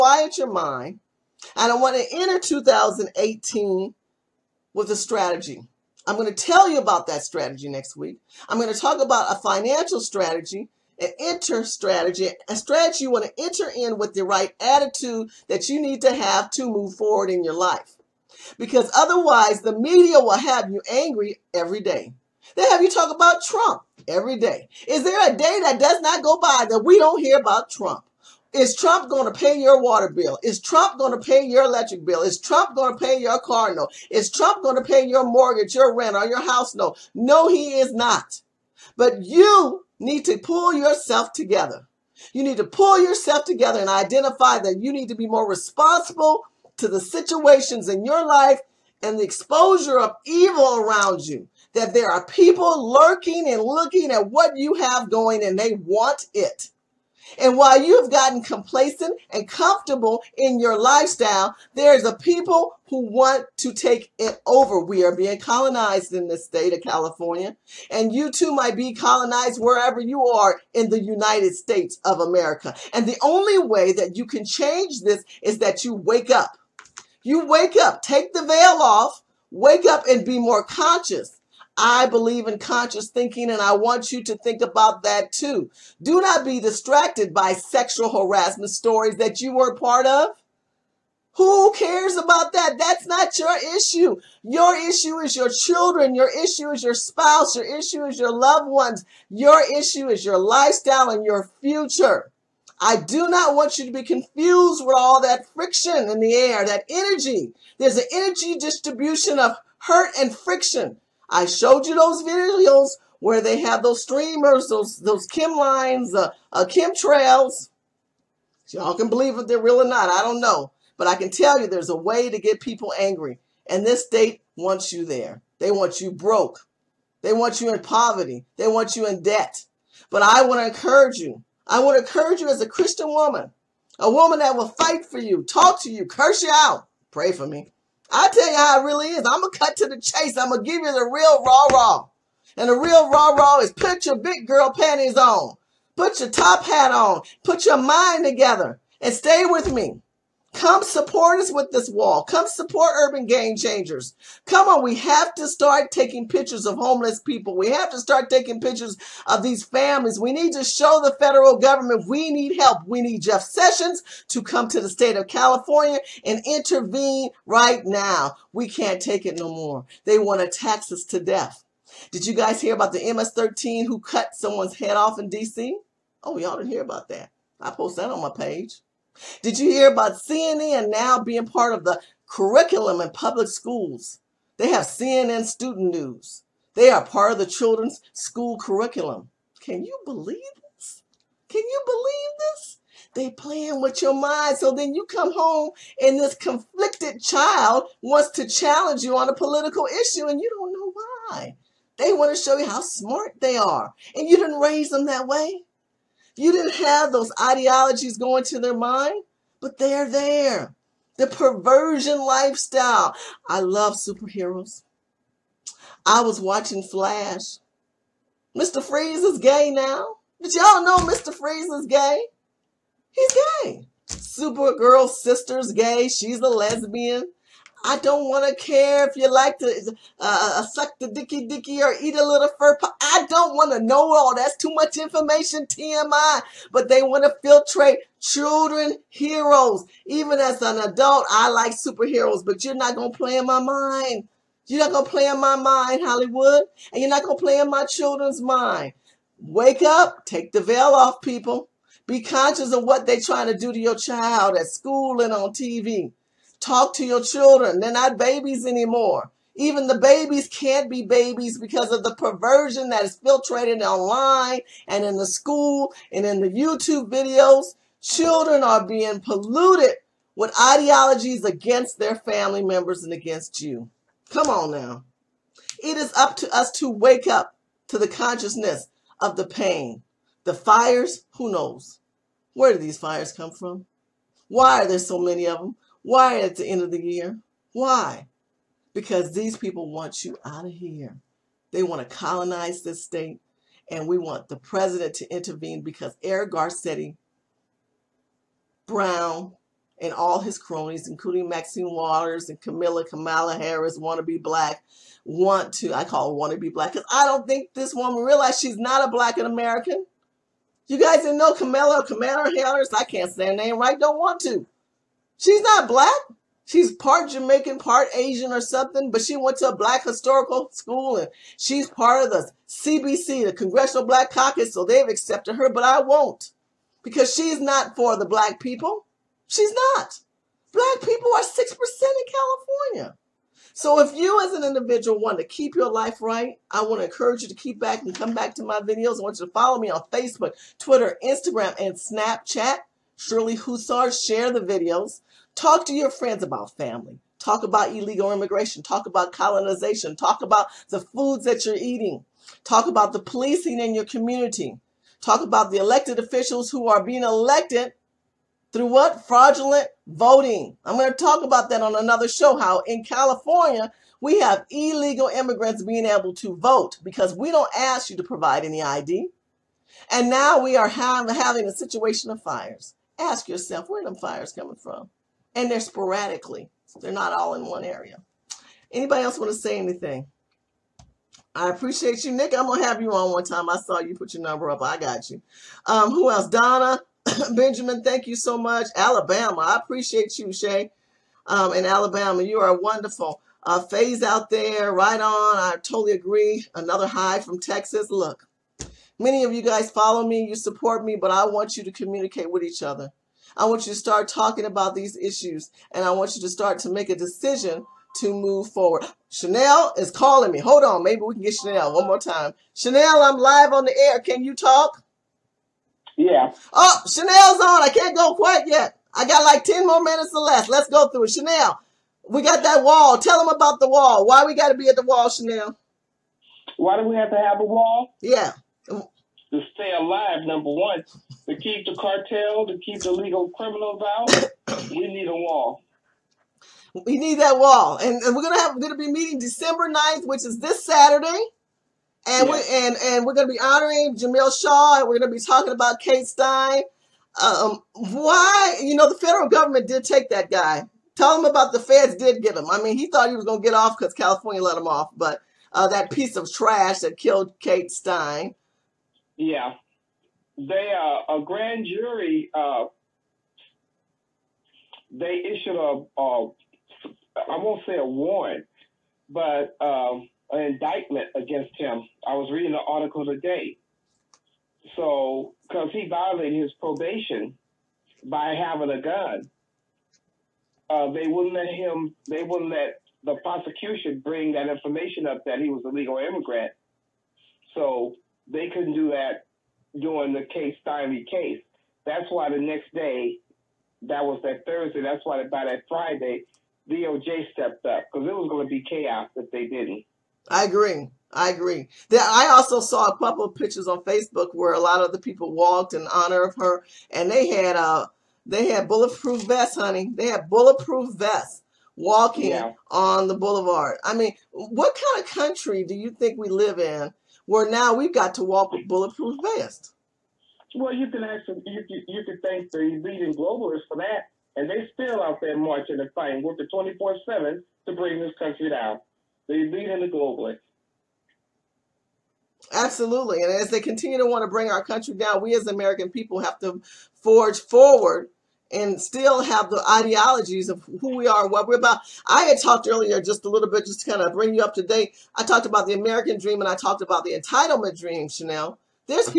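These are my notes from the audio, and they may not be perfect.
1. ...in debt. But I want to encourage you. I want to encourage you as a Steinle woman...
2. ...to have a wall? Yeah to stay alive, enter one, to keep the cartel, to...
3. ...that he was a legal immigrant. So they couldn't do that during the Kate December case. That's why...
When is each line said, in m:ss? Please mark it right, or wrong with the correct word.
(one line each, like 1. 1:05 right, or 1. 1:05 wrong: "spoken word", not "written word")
1. 2:09 wrong: "Christian", not "Steinle"
2. 7:07 wrong: "number", not "enter"
3. 8:05 wrong: "Steinle", not "December".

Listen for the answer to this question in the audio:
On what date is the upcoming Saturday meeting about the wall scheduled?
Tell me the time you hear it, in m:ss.
7:19.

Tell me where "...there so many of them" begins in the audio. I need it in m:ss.
4:44.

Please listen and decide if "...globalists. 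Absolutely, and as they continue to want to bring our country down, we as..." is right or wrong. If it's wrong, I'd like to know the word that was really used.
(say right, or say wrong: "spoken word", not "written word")
right.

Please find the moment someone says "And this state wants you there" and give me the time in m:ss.
2:03.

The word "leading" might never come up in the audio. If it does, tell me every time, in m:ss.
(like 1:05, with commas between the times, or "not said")
8:42, 8:49.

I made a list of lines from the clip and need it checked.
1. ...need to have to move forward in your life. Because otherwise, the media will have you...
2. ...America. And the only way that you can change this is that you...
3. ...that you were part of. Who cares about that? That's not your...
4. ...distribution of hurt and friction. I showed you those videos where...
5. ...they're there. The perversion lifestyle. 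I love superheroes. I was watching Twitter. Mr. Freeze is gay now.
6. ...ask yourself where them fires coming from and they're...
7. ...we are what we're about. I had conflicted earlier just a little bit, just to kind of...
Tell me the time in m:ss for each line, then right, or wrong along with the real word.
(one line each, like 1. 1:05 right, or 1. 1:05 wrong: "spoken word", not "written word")
1. 0:15 right
2. 1:12 right
3. 1:29 right
4. 1:48 right
5. 3:29 wrong: "Flash", not "Twitter"
6. 6:13 right
7. 9:01 wrong: "talked", not "conflicted".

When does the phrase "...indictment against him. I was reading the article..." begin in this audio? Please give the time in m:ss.
7:50.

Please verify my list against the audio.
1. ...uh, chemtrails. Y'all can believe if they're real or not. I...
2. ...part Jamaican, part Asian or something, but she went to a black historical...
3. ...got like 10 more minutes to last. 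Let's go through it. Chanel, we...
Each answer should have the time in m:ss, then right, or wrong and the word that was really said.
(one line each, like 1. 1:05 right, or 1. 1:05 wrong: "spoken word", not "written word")
1. 1:56 right
2. 5:16 right
3. 6:59 right.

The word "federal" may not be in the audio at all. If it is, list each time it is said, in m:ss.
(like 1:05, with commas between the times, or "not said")
2:41, 7:29.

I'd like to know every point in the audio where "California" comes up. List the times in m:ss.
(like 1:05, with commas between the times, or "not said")
1:06, 2:45, 5:32, 6:03, 7:34.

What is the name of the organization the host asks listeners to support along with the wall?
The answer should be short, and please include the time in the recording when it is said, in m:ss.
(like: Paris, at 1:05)
Urban Game Changers, at 2:32.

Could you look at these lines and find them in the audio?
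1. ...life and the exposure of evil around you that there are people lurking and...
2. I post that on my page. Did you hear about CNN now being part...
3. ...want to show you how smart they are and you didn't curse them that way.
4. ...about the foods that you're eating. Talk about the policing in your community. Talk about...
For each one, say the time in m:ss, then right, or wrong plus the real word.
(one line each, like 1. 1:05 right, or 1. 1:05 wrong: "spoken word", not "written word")
1. 0:48 right
2. 2:57 right
3. 3:22 wrong: "raise", not "curse"
4. 5:50 right.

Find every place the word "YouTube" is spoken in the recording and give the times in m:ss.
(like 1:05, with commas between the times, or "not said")
4:26.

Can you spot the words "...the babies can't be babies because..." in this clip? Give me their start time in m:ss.
4:19.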